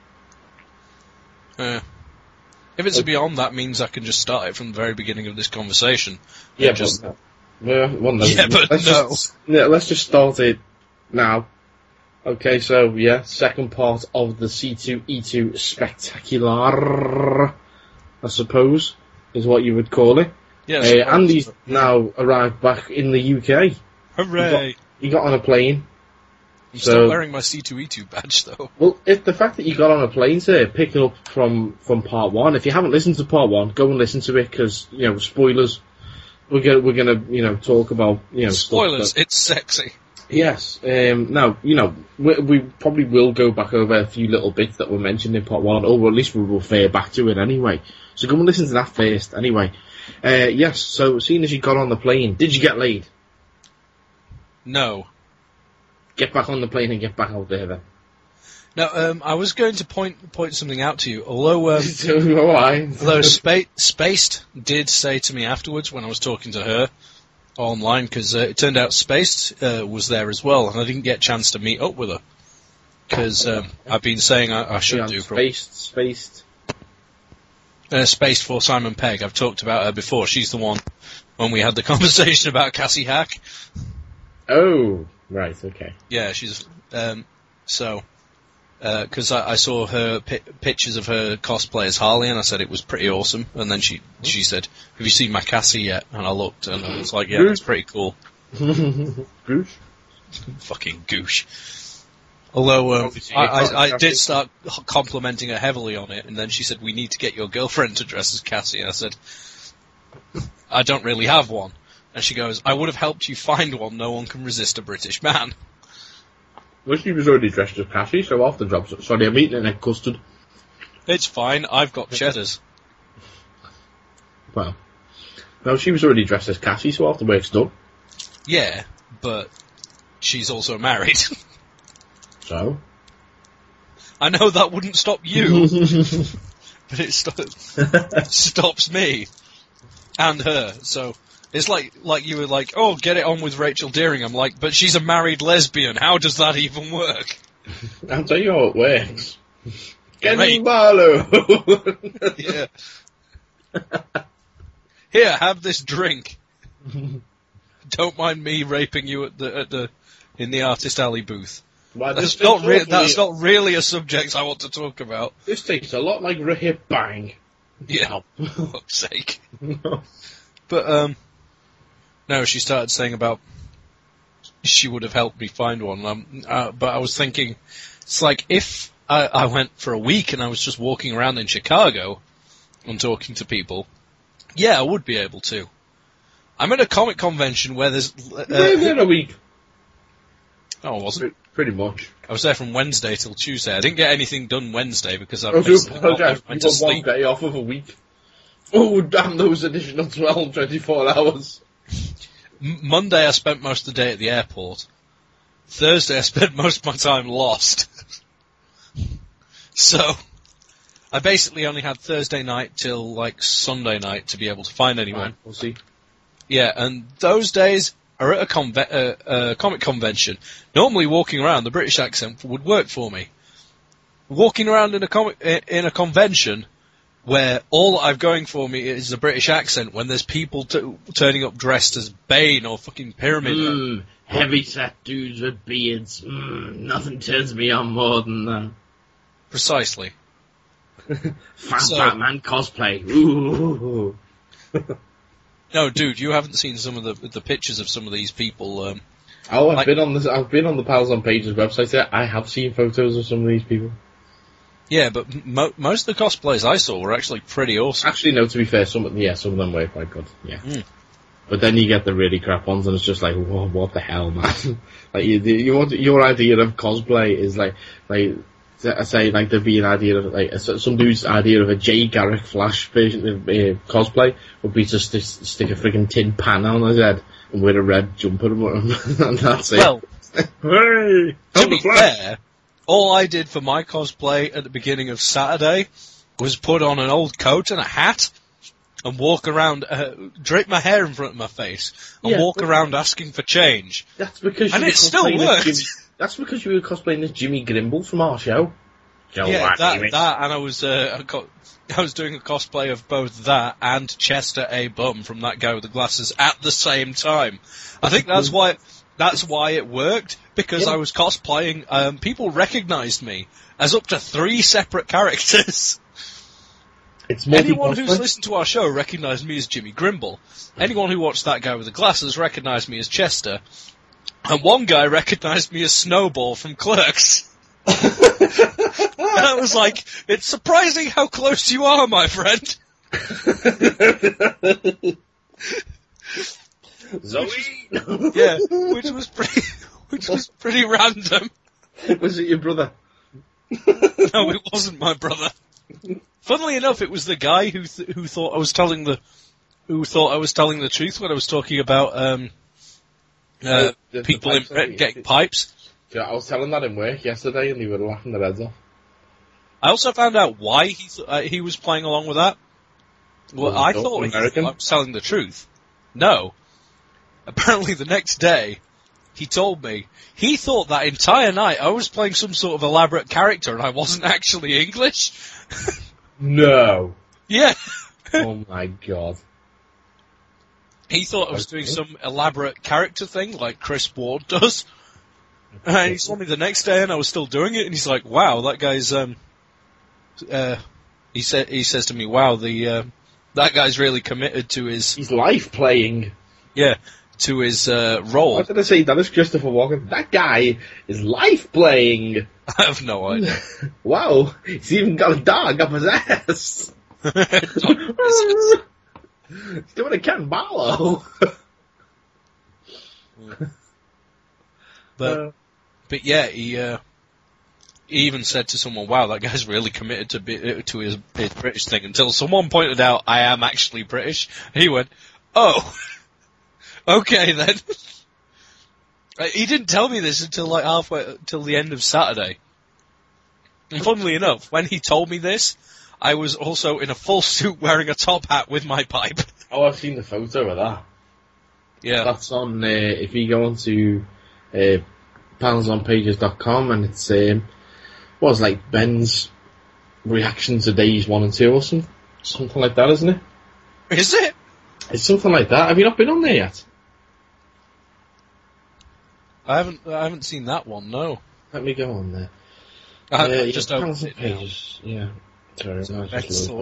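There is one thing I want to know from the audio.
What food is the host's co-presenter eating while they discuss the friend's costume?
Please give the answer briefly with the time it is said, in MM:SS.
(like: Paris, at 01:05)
egg custard, at 01:59.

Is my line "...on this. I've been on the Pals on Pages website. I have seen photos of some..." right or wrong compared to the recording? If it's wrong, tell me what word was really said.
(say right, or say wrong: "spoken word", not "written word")
right.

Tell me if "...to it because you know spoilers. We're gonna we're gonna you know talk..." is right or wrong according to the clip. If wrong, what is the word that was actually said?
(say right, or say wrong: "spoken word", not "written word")
right.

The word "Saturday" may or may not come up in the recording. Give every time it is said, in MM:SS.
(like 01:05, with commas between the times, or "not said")
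04:45, 07:12.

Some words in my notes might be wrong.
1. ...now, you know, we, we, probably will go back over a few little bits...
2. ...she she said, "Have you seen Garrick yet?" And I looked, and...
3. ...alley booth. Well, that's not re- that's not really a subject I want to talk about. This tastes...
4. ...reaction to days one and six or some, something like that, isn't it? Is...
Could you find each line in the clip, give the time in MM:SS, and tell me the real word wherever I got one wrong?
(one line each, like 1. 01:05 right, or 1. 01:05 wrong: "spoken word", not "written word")
1. 00:41 right
2. 01:33 wrong: "Cassie", not "Garrick"
3. 02:40 right
4. 07:30 wrong: "two", not "six".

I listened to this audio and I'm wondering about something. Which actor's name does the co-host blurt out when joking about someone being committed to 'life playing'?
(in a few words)
Christopher Walken.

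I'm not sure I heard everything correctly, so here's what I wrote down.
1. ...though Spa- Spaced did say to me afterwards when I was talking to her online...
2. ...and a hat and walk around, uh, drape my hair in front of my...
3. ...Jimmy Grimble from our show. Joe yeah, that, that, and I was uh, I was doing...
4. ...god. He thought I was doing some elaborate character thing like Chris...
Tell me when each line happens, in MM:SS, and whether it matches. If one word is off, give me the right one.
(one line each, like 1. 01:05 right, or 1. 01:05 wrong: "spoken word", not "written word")
1. 01:03 wrong: "although", not "though"
2. 04:47 right
3. 04:57 right
4. 06:18 right.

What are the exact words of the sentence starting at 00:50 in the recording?
Uh, yes, so seeing as you got on the plane, did you get laid?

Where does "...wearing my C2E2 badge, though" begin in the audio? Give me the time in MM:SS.
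00:27.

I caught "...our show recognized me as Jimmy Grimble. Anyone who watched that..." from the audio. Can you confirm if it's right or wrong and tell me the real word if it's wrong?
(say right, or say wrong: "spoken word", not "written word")
right.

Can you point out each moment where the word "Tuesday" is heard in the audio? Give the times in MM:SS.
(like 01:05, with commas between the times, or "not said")
03:13.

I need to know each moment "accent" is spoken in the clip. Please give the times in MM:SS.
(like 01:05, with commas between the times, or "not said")
03:41, 03:49.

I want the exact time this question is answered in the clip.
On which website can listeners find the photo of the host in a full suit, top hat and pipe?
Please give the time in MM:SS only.
07:25.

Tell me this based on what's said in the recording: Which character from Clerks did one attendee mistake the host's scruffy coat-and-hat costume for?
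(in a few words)
Snowball.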